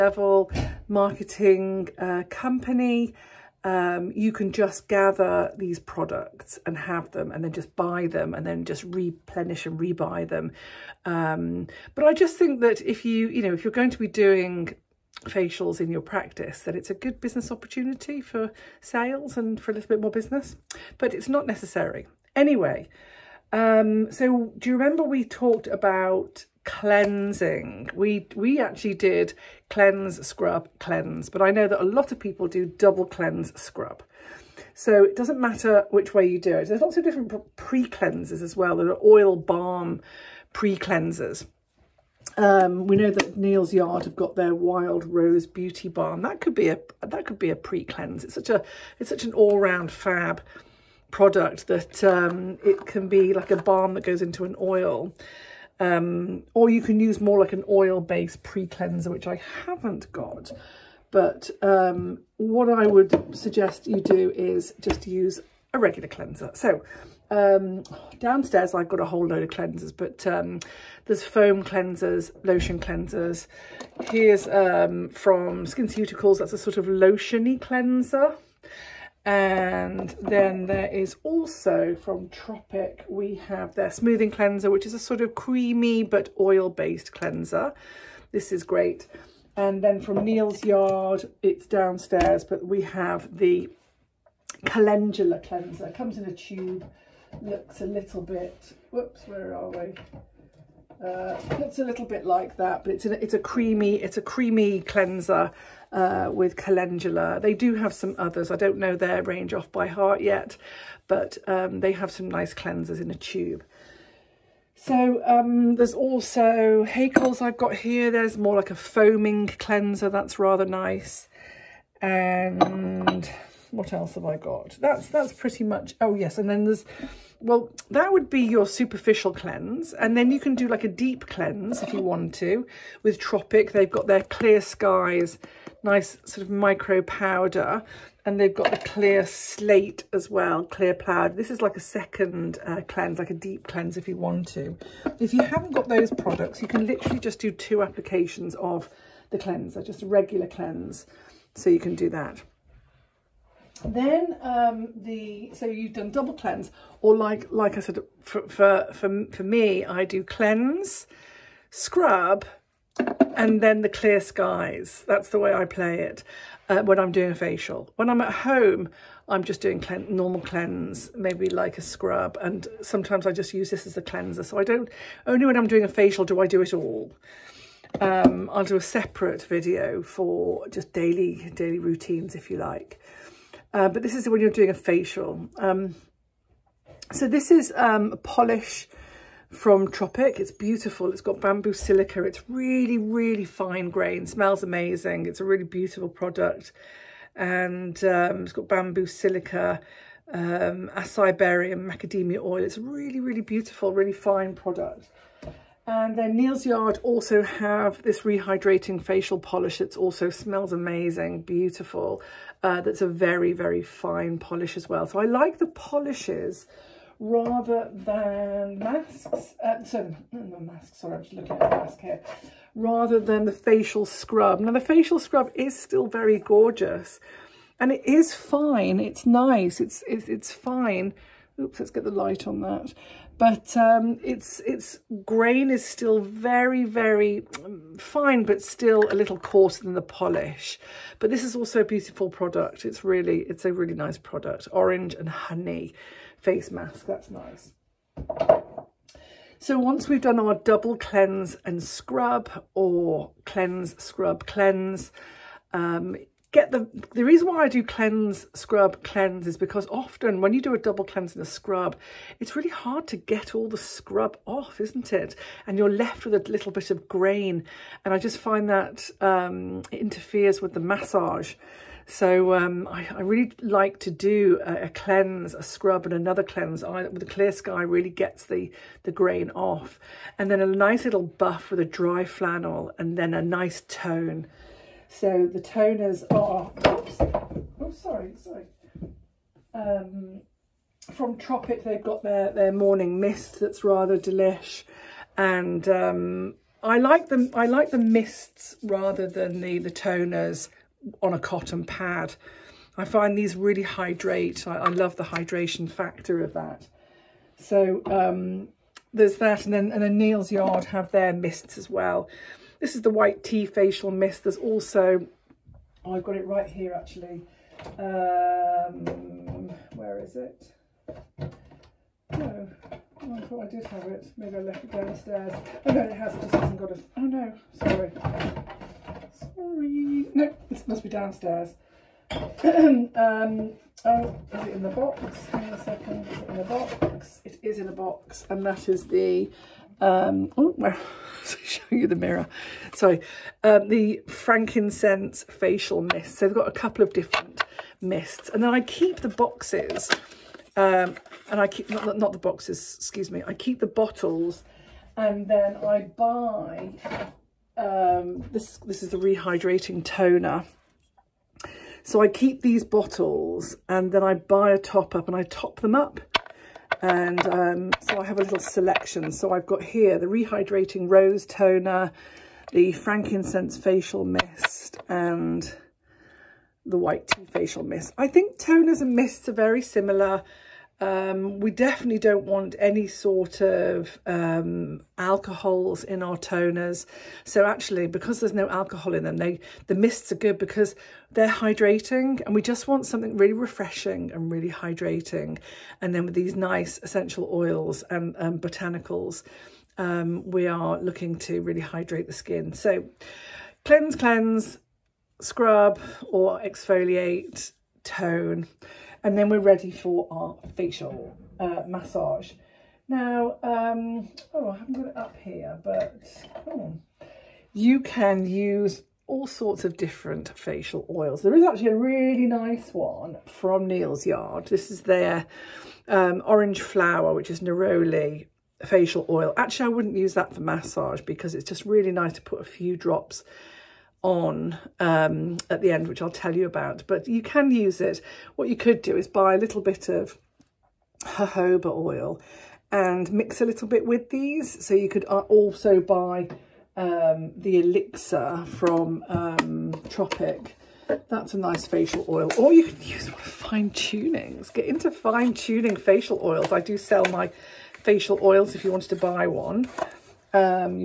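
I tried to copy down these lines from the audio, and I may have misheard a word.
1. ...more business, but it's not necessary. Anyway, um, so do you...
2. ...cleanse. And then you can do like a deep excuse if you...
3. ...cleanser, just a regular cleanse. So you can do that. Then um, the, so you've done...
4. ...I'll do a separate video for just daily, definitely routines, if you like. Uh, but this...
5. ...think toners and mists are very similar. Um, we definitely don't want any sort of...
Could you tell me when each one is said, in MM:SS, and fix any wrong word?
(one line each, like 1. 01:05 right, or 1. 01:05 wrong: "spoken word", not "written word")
1. 00:20 right
2. 02:09 wrong: "cleanse", not "excuse"
3. 02:29 right
4. 02:58 wrong: "daily", not "definitely"
5. 06:18 right.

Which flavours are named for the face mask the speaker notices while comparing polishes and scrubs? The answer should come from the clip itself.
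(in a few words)
Orange and honey.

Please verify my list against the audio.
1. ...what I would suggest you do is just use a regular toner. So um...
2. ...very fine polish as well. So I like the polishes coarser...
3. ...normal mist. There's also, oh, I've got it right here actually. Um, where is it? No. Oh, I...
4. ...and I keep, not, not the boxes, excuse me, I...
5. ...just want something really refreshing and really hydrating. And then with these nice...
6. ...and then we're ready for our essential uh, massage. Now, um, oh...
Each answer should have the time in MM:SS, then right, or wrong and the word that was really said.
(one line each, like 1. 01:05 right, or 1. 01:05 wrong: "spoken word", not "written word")
1. 01:02 wrong: "cleanser", not "toner"
2. 03:33 wrong: "rather", not "coarser"
3. 05:13 wrong: "facial", not "normal"
4. 05:51 right
5. 06:32 right
6. 06:49 wrong: "facial", not "essential".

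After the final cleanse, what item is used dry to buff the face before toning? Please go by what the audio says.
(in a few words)
Flannel.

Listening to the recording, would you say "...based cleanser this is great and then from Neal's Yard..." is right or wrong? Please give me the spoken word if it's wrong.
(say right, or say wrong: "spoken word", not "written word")
right.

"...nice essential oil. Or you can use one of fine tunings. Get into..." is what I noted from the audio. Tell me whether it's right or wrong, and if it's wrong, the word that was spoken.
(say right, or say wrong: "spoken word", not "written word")
wrong: "facial", not "essential".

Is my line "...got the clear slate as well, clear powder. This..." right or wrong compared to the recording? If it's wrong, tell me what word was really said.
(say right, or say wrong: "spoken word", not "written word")
right.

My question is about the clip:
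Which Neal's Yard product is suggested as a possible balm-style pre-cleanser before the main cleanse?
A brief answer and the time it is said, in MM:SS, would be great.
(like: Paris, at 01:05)
Wild Rose Beauty Balm, at 00:44.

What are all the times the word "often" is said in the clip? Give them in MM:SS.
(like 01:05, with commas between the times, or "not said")
04:19.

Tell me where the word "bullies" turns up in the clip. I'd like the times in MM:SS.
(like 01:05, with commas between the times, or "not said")
not said.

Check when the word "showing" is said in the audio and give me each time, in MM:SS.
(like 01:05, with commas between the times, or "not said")
05:41.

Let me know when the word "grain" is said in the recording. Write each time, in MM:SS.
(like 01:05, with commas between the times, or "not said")
03:13, 03:55, 04:27, 04:39.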